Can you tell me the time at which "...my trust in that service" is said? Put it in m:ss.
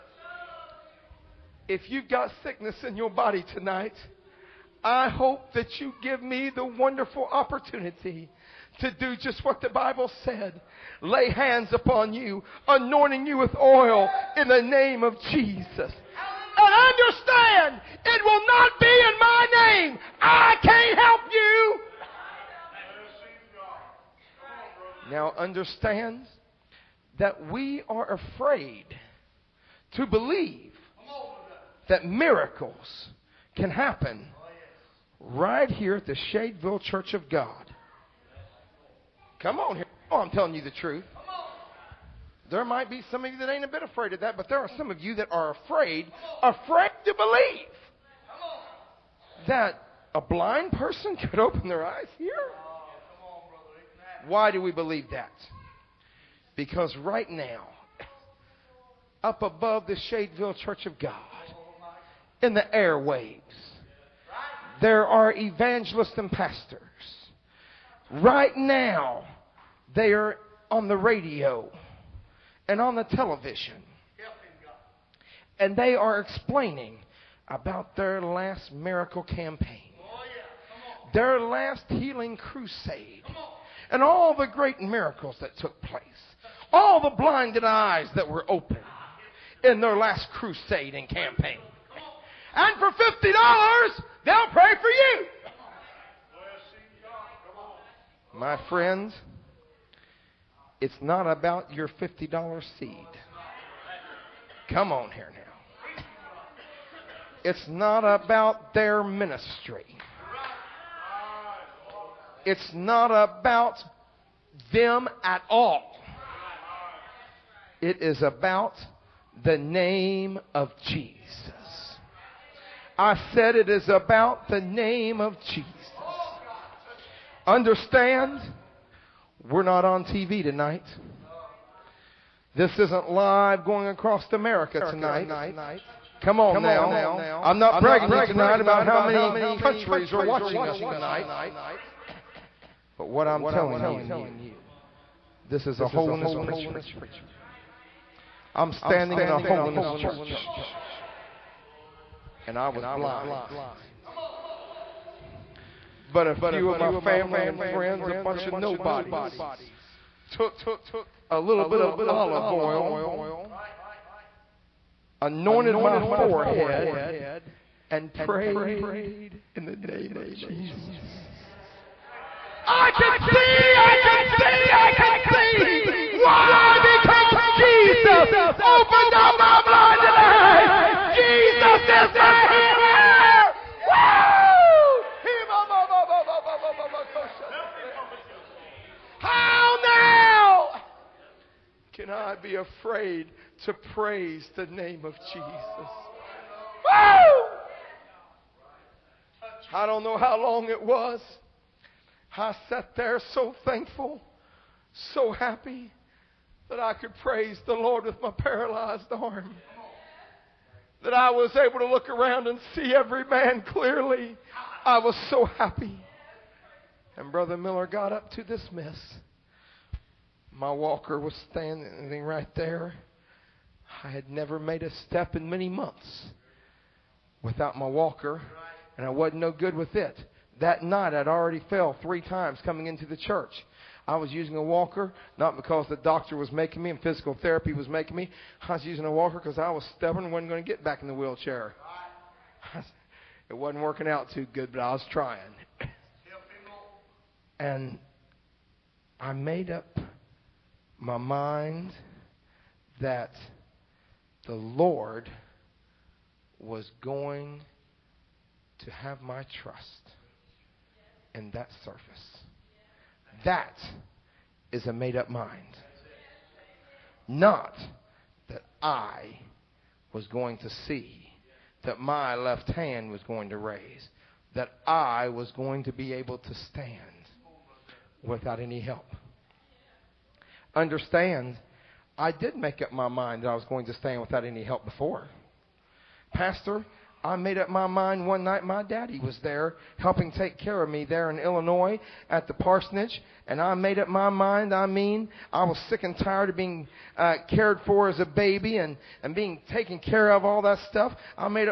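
4:19.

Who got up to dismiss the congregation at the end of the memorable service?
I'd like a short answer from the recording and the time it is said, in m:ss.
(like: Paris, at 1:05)
Brother Miller, at 3:37.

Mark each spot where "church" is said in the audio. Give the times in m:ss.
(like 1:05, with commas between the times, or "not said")
0:36, 1:00, 2:30, 3:53.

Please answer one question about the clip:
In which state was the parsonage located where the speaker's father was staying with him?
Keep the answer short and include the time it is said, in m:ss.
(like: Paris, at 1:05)
Illinois, at 4:51.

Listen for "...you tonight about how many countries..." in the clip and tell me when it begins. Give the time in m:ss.
2:18.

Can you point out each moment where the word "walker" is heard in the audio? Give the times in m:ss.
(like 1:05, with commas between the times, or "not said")
3:40, 3:47, 3:54, 3:59.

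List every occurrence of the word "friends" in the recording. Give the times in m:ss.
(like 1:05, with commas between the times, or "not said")
1:38, 2:37.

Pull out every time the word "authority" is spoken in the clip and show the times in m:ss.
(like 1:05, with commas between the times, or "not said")
not said.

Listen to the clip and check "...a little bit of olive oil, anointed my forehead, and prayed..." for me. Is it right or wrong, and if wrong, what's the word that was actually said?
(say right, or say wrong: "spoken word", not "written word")
right.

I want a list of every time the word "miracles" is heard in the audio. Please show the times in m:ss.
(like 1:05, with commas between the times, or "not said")
0:32, 1:18, 1:24.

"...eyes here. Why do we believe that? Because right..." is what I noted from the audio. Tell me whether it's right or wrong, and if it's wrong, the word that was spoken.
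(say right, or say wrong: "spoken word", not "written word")
right.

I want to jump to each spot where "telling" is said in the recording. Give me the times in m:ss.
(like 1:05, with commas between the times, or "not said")
0:40, 2:23.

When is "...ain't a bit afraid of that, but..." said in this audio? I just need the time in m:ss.
0:43.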